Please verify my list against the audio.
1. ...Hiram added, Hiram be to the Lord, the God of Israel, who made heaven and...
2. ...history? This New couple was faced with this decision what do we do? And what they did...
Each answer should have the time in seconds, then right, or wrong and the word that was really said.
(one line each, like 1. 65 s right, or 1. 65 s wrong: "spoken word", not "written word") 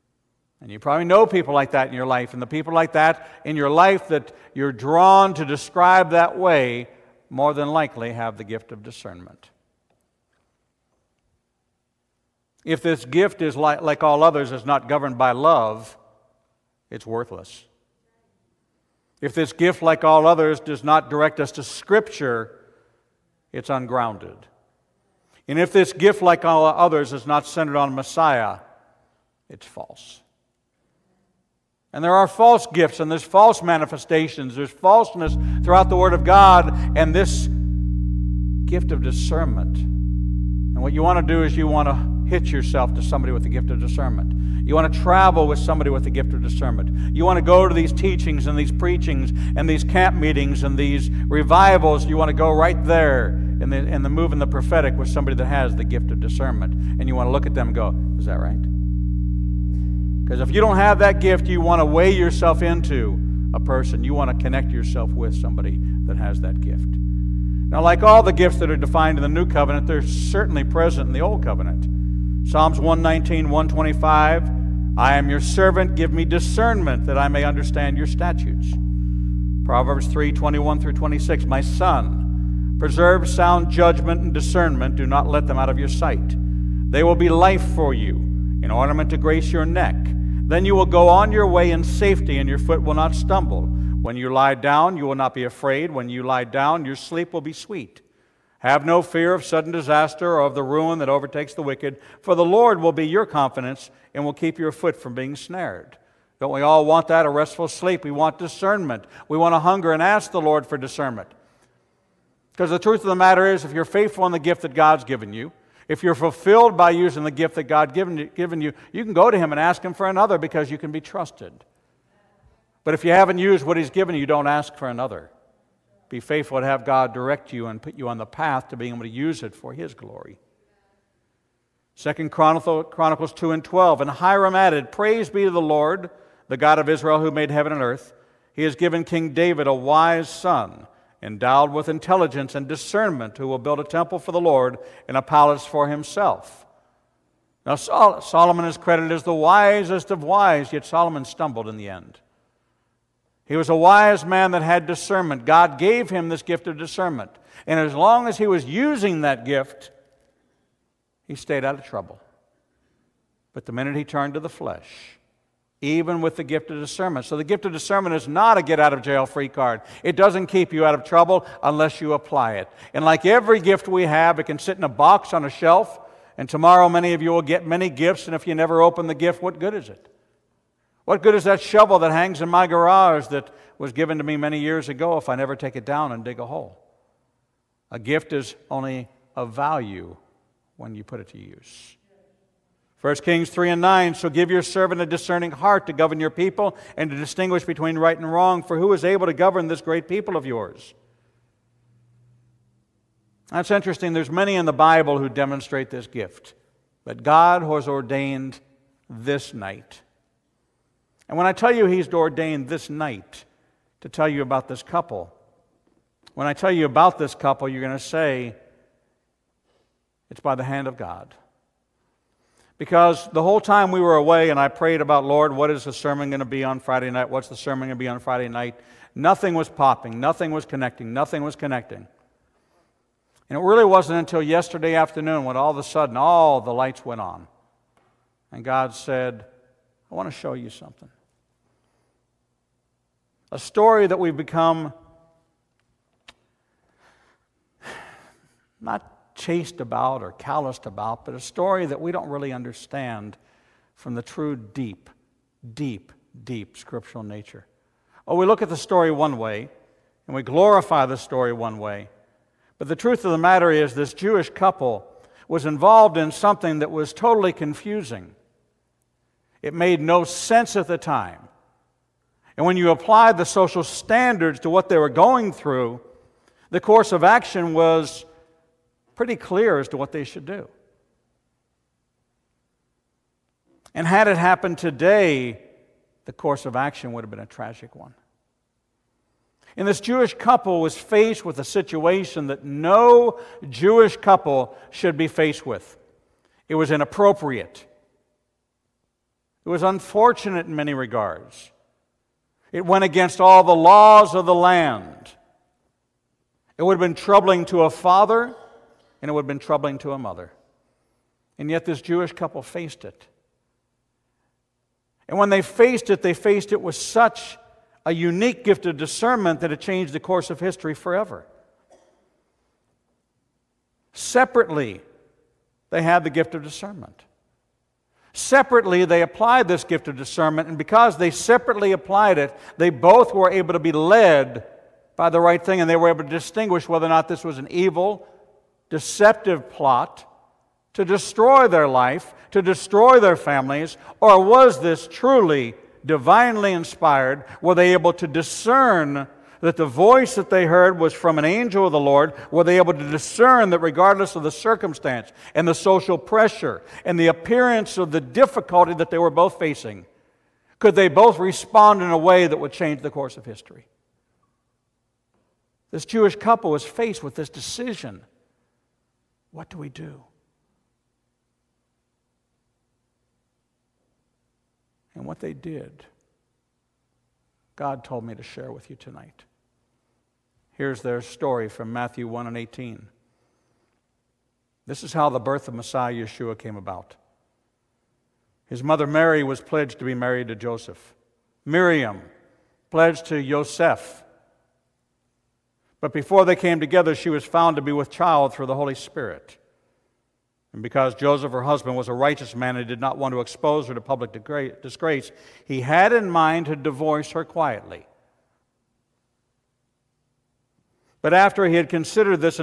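1. 134 s wrong: "Praise", not "Hiram"
2. 363 s wrong: "Jewish", not "New".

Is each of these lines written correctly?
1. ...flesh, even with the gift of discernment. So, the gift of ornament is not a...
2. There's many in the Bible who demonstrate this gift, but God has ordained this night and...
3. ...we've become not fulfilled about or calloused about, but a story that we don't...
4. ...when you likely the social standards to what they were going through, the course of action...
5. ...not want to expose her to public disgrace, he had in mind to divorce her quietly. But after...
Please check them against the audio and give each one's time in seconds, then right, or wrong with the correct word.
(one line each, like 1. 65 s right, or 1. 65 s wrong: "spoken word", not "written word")
1. 164 s wrong: "discernment", not "ornament"
2. 204 s right
3. 244 s wrong: "chased", not "fulfilled"
4. 272 s wrong: "apply", not "likely"
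5. 402 s right.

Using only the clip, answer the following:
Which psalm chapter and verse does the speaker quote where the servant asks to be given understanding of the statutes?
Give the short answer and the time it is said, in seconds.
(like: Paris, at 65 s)
Psalms 119:125, at 72 s.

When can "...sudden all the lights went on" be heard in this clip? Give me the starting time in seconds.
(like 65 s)
235 s.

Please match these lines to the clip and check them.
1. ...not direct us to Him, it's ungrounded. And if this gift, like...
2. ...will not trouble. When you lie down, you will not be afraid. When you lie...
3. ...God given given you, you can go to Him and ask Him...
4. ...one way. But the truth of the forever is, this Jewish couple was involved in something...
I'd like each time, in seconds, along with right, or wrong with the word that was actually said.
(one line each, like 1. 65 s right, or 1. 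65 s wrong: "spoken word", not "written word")
1. 20 s wrong: "Scripture", not "Him"
2. 92 s wrong: "stumble", not "trouble"
3. 117 s right
4. 261 s wrong: "matter", not "forever".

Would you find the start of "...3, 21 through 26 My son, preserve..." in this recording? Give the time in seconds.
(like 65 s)
80 s.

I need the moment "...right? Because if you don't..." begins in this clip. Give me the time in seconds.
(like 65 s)
58 s.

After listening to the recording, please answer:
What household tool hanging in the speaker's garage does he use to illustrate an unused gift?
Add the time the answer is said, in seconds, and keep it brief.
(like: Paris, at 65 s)
shovel, at 181 s.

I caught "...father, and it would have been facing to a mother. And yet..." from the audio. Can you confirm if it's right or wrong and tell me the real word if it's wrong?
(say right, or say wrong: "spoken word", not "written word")
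wrong: "troubling", not "facing".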